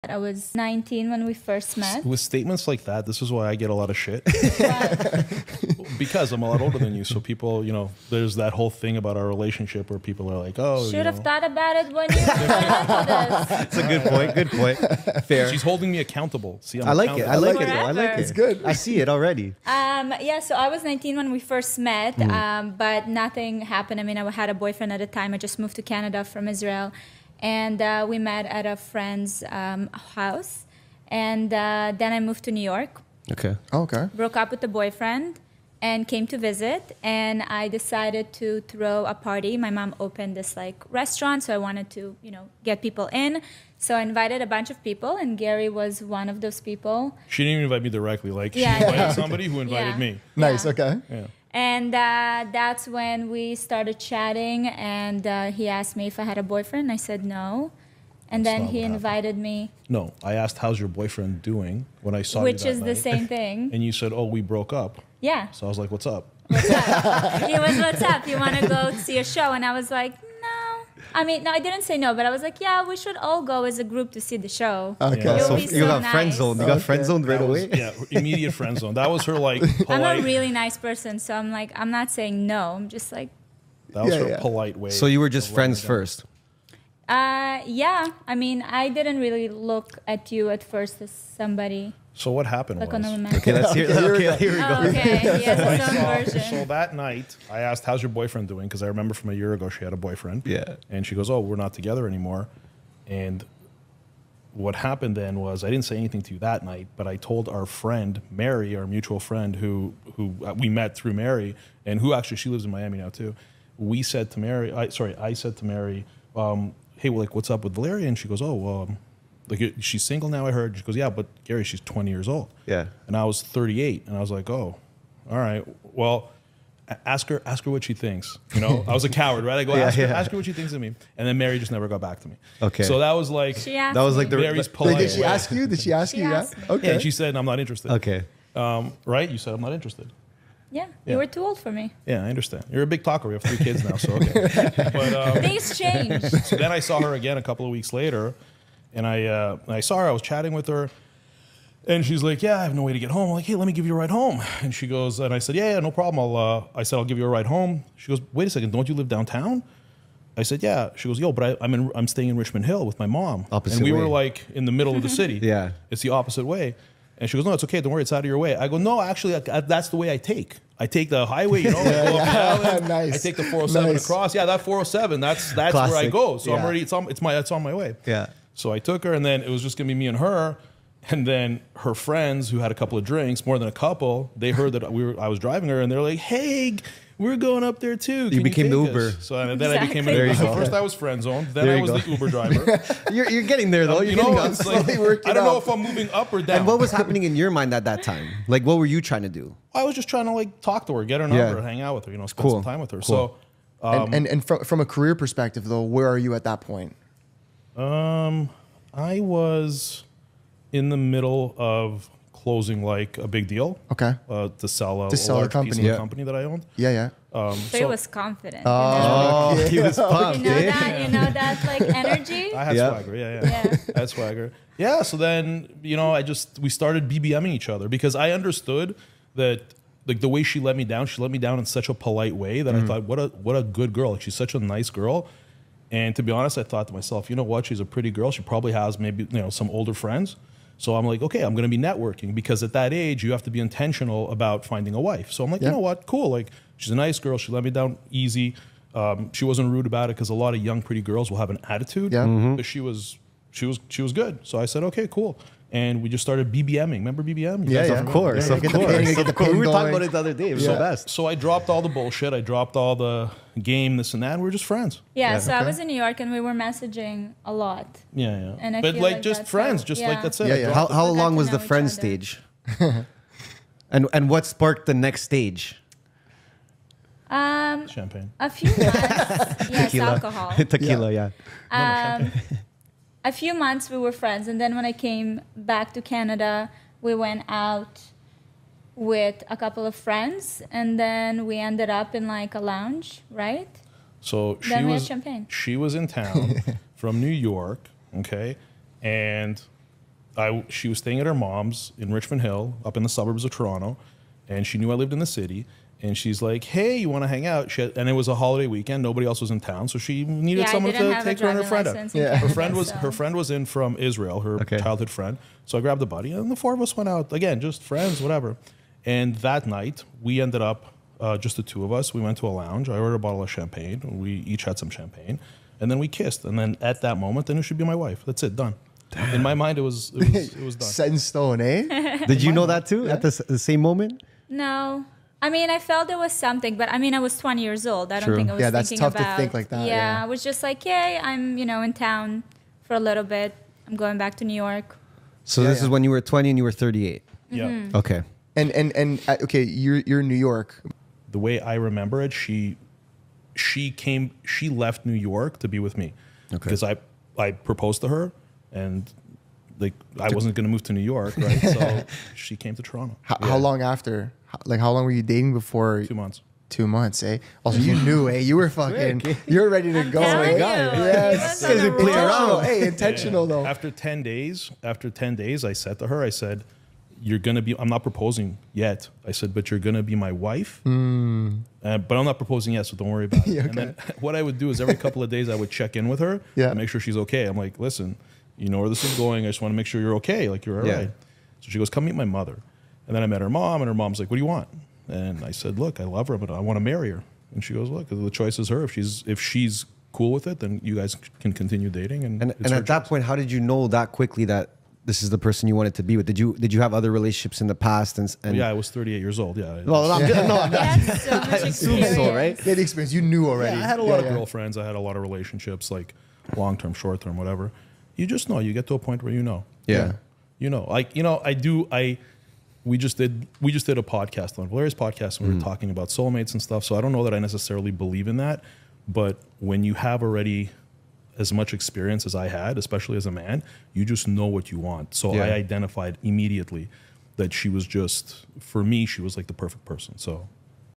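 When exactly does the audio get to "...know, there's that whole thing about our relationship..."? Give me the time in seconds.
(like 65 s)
7 s.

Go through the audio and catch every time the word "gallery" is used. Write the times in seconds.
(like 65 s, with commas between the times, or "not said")
not said.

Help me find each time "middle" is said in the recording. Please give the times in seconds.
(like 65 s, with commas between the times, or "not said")
164 s, 210 s.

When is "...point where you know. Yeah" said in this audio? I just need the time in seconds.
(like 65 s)
418 s.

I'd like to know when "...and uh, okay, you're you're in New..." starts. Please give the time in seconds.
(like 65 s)
349 s.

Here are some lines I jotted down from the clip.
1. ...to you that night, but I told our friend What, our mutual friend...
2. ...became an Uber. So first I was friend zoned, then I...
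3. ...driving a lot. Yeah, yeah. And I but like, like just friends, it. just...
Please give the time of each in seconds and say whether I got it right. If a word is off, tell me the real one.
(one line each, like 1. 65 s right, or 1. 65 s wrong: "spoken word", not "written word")
1. 106 s wrong: "Mary", not "What"
2. 189 s right
3. 266 s wrong: "messaging", not "driving".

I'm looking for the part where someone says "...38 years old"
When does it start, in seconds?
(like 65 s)
408 s.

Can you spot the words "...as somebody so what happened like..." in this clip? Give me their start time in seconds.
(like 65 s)
91 s.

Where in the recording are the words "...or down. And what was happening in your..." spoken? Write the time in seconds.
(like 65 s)
196 s.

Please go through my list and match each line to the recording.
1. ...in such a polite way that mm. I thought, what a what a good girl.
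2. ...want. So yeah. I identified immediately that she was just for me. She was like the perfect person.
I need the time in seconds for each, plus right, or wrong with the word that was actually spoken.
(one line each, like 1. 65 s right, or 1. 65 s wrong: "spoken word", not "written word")
1. 231 s right
2. 434 s right.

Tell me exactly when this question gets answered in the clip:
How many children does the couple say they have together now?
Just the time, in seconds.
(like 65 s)
143 s.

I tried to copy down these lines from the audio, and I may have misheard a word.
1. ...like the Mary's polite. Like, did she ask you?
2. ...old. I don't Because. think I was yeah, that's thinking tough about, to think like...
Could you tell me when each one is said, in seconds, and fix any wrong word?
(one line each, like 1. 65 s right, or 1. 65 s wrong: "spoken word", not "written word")
1. 134 s right
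2. 337 s wrong: "True", not "Because".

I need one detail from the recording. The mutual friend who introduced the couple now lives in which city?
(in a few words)
Miami.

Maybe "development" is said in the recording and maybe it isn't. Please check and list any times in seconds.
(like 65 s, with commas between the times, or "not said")
not said.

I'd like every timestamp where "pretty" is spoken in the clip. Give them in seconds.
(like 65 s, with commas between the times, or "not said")
237 s, 250 s.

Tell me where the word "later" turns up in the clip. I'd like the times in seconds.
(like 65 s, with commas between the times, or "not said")
147 s.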